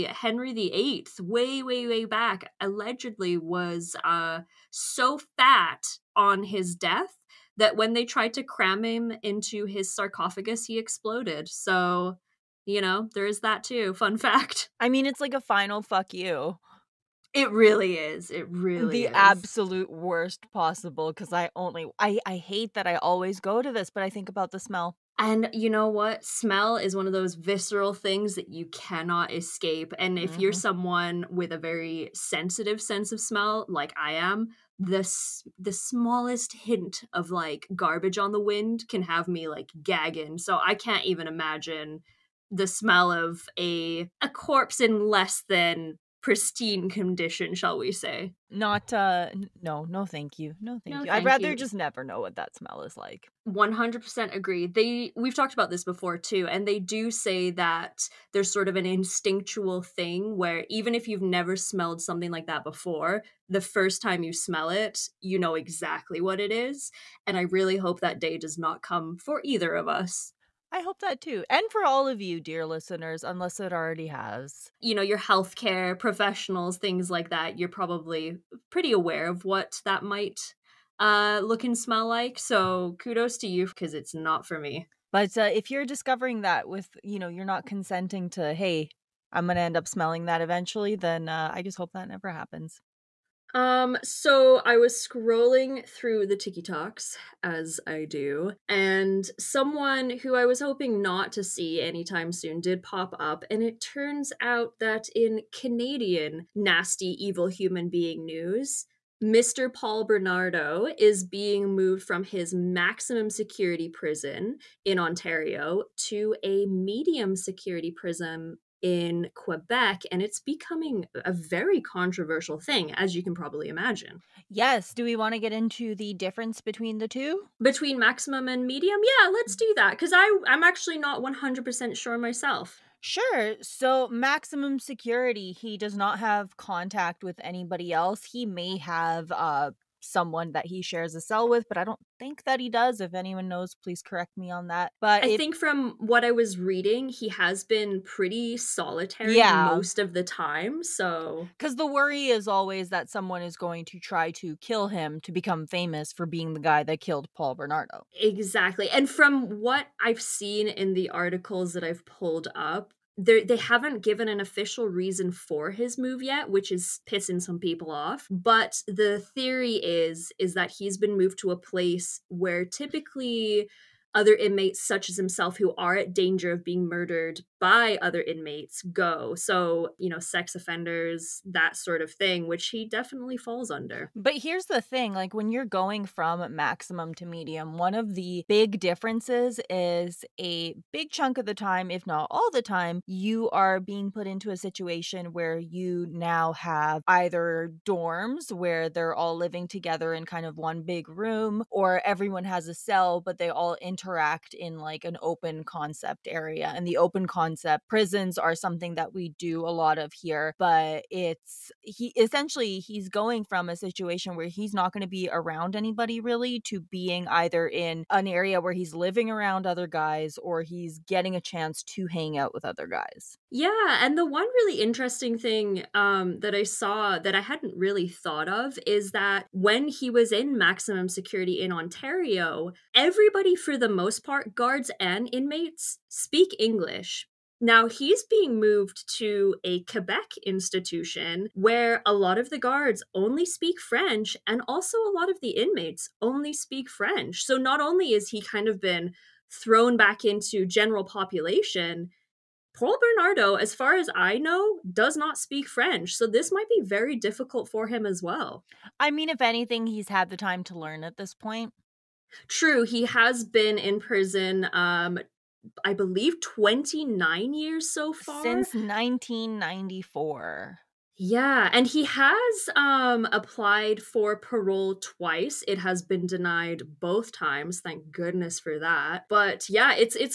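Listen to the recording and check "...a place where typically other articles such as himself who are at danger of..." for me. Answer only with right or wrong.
wrong.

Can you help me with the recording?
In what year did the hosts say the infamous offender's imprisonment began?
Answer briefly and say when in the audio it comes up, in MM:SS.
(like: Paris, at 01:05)
1994, at 04:28.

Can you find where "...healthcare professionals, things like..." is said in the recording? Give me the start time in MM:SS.
01:15.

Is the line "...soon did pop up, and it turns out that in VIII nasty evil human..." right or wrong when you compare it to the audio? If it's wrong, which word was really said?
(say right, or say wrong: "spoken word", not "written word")
wrong: "Canadian", not "VIII".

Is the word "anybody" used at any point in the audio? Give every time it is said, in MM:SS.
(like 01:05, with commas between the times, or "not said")
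02:17, 03:35.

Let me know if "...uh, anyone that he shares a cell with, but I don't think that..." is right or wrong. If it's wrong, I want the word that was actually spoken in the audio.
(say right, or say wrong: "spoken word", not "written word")
wrong: "someone", not "anyone".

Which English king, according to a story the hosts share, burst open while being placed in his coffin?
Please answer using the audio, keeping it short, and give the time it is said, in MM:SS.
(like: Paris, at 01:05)
Henry VIII, at 00:00.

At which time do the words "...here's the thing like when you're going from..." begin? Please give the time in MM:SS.
03:04.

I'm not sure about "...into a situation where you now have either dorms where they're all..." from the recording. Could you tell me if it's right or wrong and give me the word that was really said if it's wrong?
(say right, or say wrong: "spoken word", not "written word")
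right.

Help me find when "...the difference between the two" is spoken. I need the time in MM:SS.
02:05.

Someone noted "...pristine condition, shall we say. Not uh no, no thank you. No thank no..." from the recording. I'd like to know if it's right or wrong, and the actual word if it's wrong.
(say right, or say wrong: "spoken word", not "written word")
right.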